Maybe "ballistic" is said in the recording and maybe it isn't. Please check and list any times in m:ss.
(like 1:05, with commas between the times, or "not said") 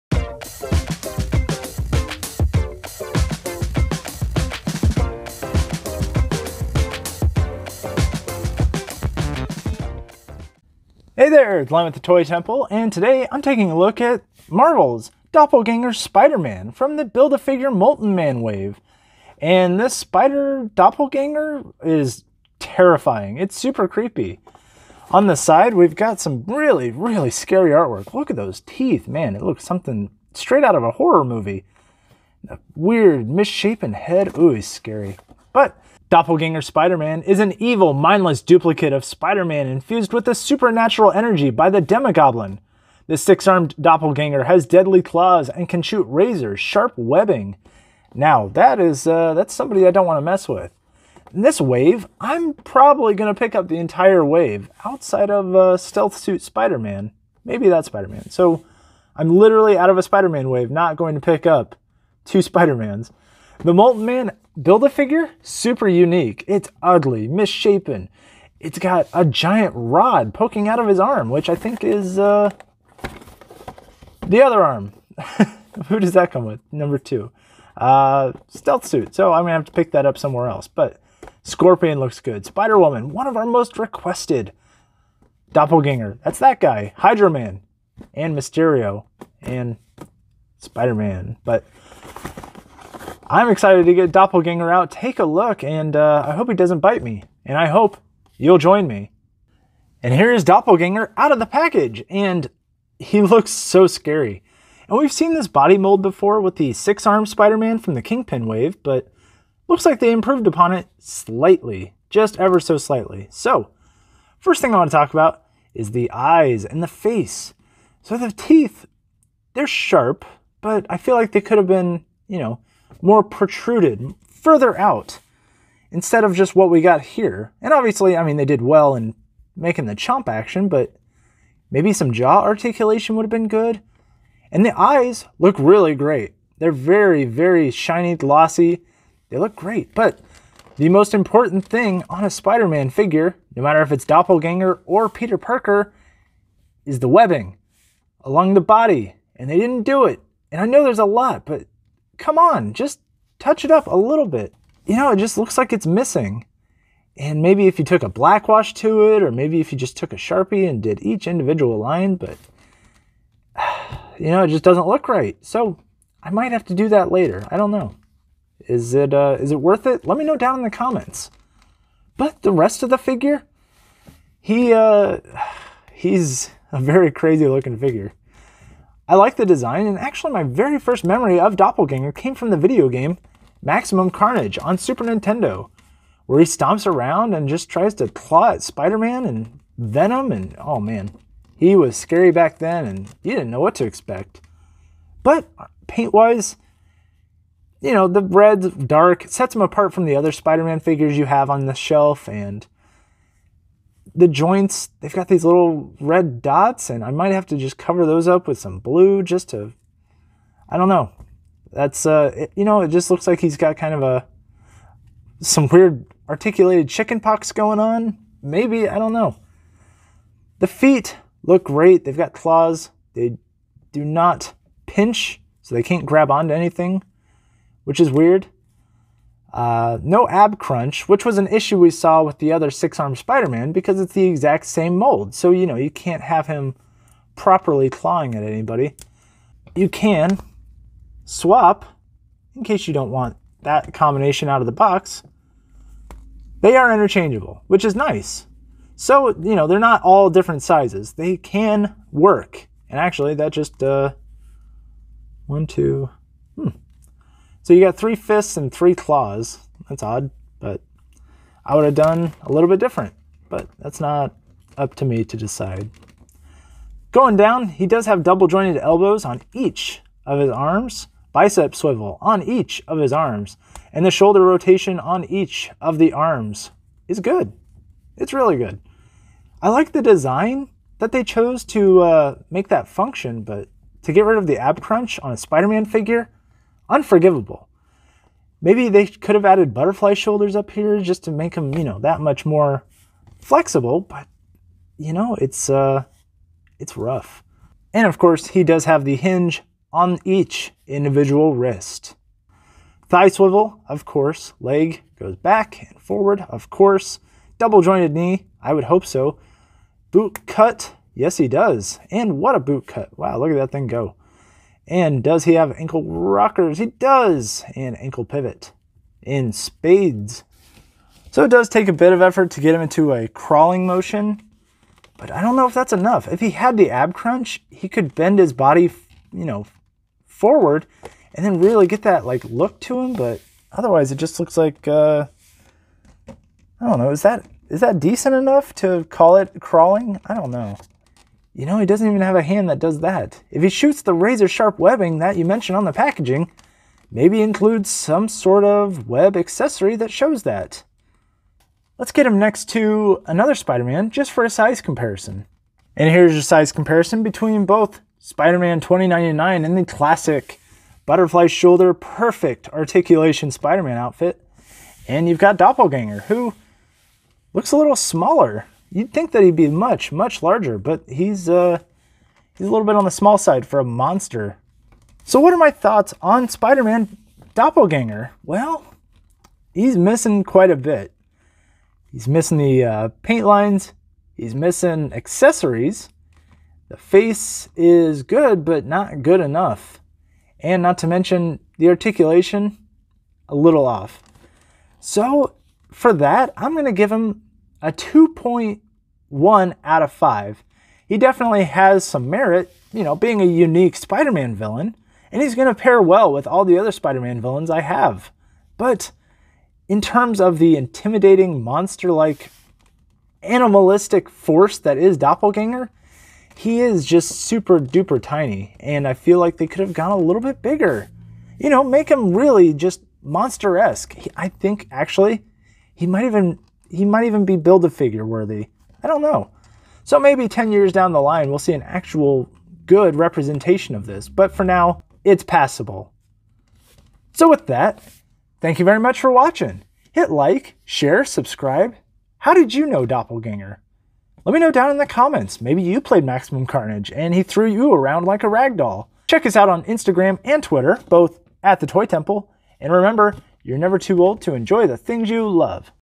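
not said.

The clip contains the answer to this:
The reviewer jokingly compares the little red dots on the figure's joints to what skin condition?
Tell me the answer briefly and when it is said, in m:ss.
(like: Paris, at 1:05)
chicken pox, at 3:36.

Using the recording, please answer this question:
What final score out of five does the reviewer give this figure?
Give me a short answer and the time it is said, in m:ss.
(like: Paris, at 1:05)
2.1, at 6:37.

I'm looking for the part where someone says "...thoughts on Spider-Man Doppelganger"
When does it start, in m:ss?
6:15.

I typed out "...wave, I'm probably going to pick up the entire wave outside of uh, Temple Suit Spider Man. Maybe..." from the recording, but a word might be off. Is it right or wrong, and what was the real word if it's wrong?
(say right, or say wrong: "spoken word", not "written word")
wrong: "Stealth", not "Temple".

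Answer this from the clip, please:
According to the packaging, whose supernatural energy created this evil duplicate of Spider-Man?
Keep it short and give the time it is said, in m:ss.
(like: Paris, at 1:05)
Demogoblin, at 0:41.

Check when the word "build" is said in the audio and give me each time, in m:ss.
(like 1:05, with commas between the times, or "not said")
0:17, 1:04, 7:07.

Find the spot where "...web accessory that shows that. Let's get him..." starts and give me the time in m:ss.
5:49.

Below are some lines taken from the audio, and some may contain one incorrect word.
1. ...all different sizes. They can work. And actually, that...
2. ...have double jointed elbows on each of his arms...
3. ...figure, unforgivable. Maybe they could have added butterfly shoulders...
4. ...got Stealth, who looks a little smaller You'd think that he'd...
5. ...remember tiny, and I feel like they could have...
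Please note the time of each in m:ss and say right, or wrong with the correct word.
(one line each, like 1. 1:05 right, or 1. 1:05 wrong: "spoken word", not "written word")
1. 4:10 right
2. 4:28 right
3. 4:45 right
4. 6:05 wrong: "Doppelganger", not "Stealth"
5. 6:57 wrong: "duper", not "remember".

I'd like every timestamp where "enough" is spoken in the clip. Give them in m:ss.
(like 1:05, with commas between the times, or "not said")
5:25, 5:38, 6:29.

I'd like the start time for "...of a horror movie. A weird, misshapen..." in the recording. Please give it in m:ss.
0:30.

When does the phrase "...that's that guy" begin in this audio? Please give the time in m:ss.
1:26.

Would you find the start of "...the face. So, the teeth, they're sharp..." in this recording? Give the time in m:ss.
1:56.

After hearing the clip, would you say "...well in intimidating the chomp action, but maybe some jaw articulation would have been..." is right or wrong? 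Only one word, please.
wrong.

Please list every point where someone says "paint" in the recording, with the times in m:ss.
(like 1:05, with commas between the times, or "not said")
3:15, 6:23.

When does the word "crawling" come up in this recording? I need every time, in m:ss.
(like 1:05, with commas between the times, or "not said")
5:23, 5:39.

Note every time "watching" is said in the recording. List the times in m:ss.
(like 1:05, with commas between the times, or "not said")
7:19.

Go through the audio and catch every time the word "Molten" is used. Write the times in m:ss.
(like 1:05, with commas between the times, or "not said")
0:17, 1:03.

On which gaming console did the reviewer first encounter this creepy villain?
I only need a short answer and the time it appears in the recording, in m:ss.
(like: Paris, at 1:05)
Super Nintendo, at 3:04.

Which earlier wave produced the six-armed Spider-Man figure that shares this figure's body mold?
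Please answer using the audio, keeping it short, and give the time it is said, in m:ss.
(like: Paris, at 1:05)
Kingpin, at 1:48.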